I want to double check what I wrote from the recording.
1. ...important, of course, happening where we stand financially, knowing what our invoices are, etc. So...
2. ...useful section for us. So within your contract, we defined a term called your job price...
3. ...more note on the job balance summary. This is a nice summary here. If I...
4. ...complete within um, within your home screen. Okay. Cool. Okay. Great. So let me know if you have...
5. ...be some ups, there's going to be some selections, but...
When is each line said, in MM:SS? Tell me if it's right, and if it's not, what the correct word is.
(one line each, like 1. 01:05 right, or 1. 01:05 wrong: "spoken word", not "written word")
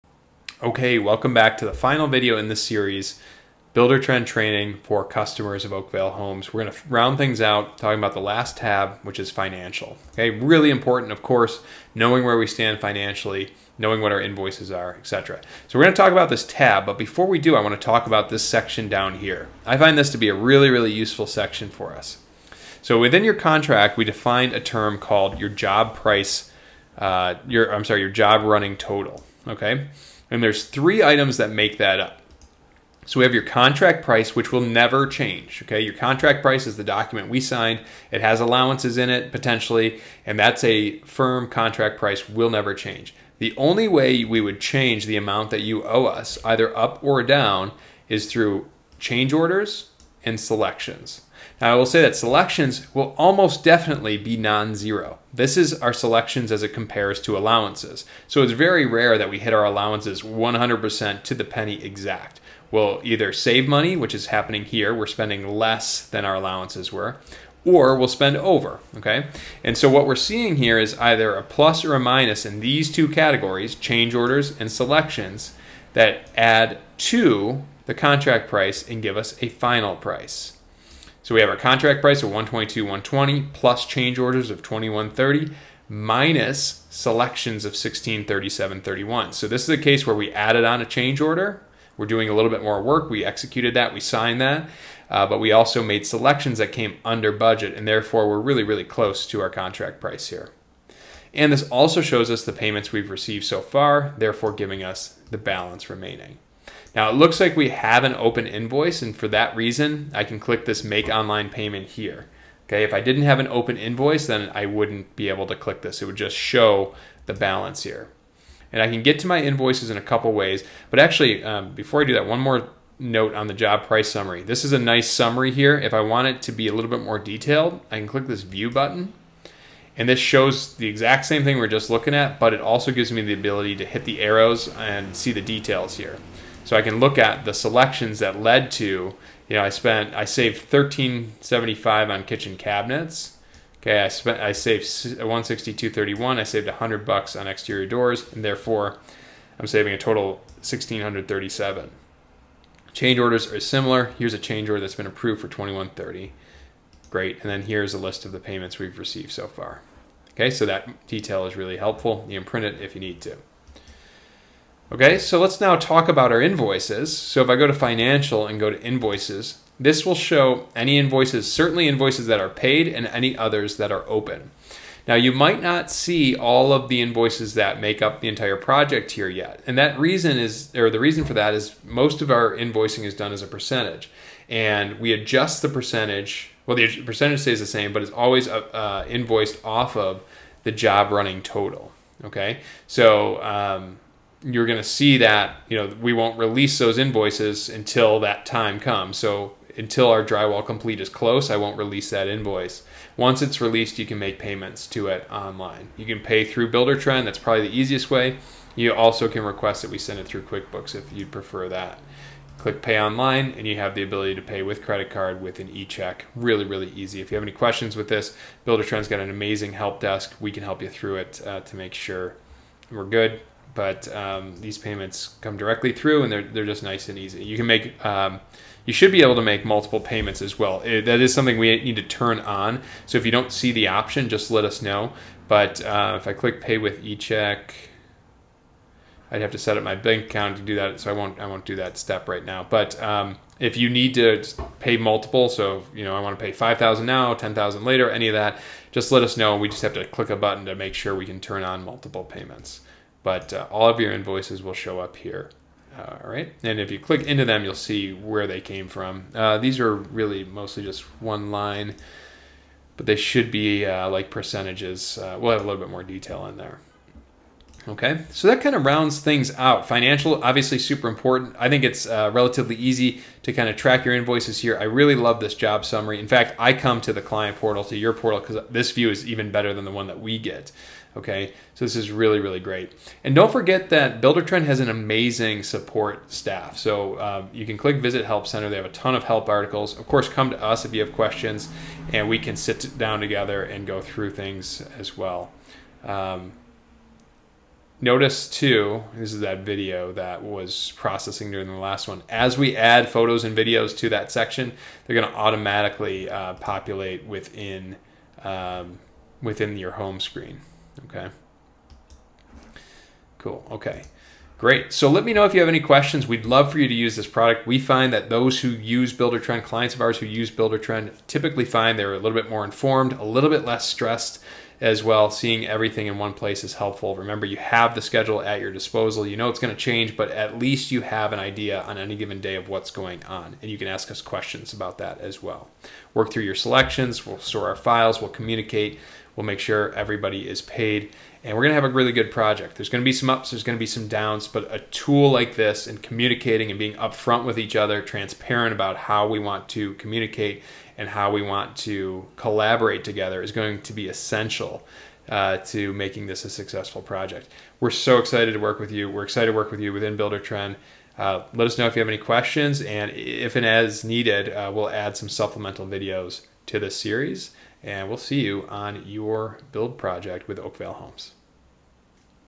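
1. 00:10 wrong: "knowing", not "happening"
2. 00:20 right
3. 02:02 wrong: "price", not "balance"
4. 05:06 wrong: "populate", not "complete"
5. 05:43 wrong: "downs", not "selections".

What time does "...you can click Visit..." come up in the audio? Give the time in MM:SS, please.
04:47.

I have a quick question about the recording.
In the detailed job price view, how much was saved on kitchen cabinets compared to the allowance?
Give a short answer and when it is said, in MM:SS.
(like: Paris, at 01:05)
1375, at 02:20.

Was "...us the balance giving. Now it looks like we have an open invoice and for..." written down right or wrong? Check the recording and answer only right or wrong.
wrong.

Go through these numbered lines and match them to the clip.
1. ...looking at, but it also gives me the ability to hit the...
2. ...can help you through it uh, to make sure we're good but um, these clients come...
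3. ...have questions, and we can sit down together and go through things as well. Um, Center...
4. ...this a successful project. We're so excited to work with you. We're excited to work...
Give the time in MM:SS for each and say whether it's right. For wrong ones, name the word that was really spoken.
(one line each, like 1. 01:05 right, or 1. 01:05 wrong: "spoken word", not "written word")
1. 02:11 right
2. 03:40 wrong: "payments", not "clients"
3. 04:51 wrong: "Notice", not "Center"
4. 05:56 right.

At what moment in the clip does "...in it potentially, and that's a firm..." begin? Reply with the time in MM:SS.
00:38.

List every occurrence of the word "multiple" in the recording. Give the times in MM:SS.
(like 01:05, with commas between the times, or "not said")
03:49, 04:04, 04:11.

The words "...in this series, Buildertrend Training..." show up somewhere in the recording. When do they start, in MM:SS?
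00:02.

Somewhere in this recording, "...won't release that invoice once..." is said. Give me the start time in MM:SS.
03:21.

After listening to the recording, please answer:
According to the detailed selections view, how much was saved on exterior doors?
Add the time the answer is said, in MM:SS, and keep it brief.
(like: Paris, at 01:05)
100 bucks, at 02:26.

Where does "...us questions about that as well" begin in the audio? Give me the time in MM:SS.
05:34.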